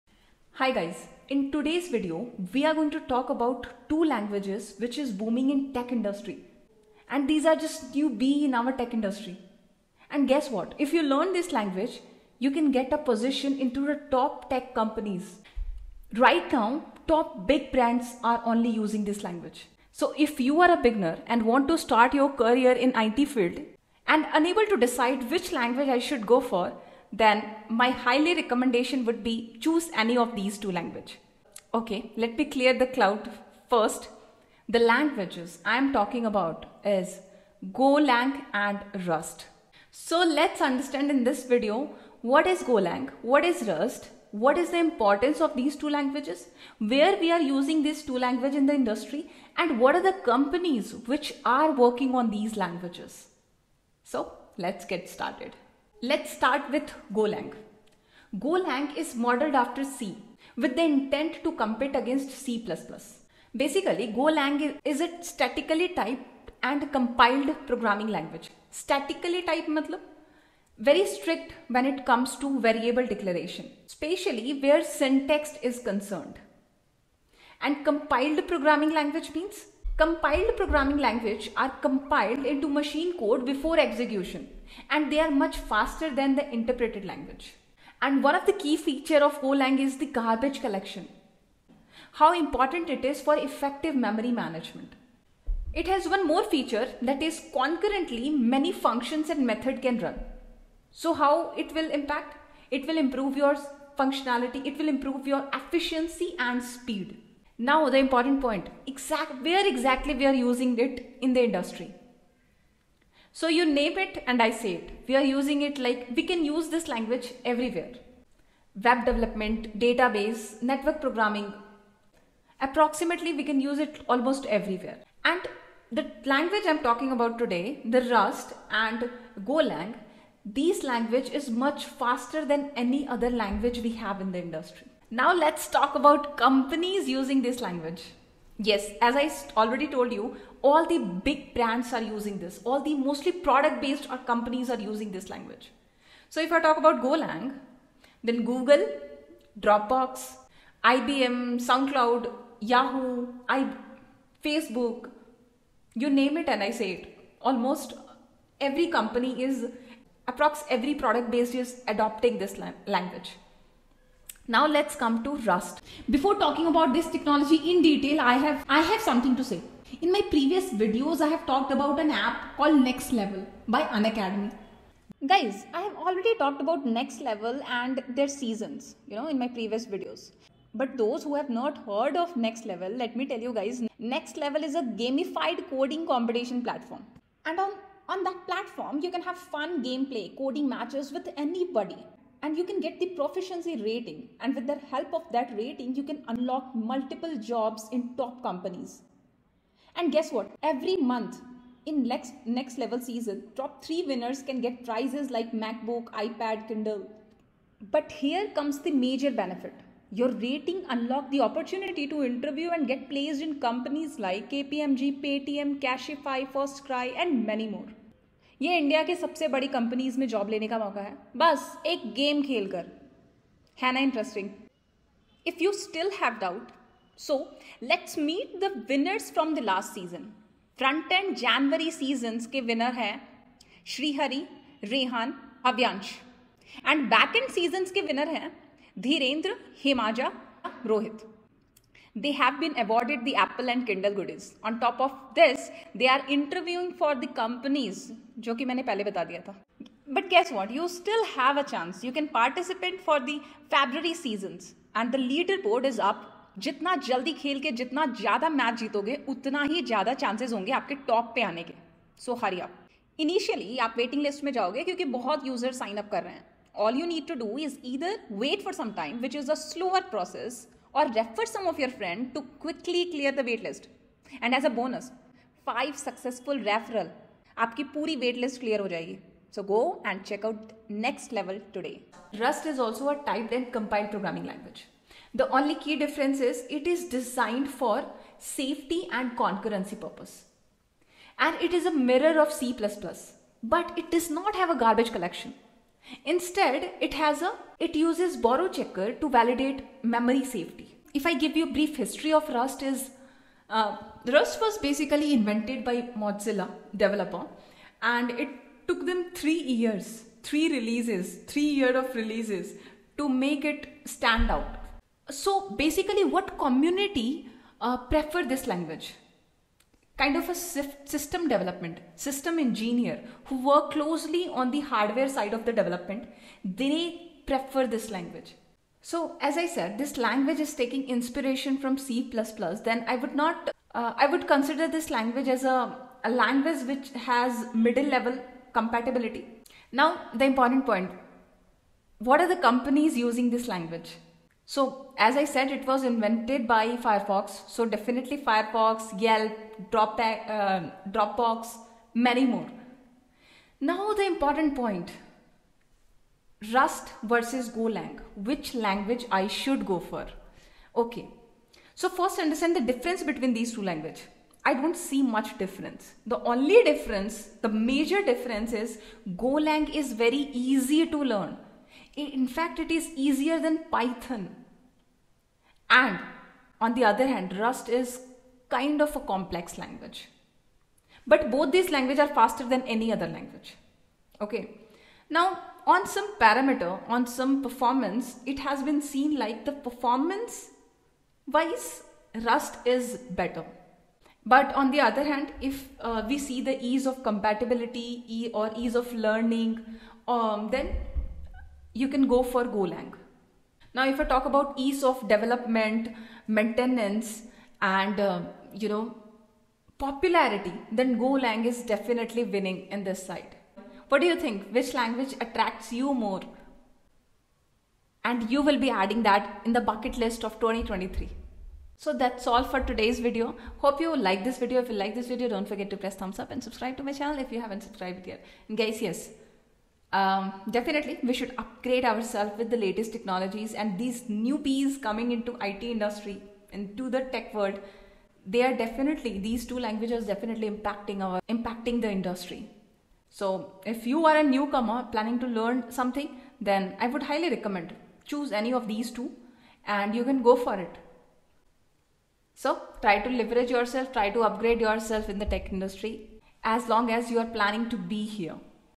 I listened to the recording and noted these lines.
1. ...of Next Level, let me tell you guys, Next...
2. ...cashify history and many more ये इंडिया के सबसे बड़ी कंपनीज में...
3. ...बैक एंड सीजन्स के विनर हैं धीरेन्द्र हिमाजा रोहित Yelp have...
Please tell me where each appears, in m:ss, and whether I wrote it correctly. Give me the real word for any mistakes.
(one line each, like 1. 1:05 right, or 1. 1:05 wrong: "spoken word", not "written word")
1. 3:02 right
2. 3:35 wrong: "firstcry", not "history"
3. 3:57 wrong: "They", not "Yelp".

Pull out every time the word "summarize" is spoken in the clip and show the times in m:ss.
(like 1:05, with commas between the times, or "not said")
not said.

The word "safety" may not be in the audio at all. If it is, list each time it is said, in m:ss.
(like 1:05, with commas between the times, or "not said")
4:48, 5:00.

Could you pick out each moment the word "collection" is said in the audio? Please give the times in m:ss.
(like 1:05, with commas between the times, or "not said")
1:30, 4:55.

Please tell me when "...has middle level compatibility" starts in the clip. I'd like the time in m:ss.
5:37.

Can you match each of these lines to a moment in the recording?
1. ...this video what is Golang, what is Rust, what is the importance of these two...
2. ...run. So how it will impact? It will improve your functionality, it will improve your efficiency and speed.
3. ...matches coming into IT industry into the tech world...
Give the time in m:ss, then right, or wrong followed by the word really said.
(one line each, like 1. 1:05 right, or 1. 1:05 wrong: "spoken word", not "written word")
1. 0:41 right
2. 1:39 right
3. 7:14 wrong: "newbies", not "matches".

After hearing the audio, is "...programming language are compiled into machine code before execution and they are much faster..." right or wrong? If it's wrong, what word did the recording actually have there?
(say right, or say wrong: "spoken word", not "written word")
right.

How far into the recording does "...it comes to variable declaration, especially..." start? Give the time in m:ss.
1:11.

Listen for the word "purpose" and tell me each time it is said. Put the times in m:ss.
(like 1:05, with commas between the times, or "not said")
4:49.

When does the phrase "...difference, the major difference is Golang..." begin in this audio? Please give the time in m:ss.
6:06.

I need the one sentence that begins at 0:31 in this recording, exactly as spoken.
Okay, let me clear the cloud first.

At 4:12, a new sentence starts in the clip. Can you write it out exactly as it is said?
You can participate for the February seasons.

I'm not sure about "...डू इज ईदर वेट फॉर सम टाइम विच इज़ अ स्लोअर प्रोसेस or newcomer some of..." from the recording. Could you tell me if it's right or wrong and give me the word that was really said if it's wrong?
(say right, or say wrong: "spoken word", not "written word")
wrong: "refer", not "newcomer".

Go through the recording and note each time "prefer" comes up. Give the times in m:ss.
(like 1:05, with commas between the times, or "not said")
5:17, 5:27.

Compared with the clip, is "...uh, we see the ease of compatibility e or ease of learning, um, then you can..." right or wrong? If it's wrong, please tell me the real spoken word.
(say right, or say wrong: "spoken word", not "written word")
right.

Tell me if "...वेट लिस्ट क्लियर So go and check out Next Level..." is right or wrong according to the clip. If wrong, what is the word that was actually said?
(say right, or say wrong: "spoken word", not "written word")
right.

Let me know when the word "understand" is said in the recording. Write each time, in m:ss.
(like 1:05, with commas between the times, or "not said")
0:40, 6:02.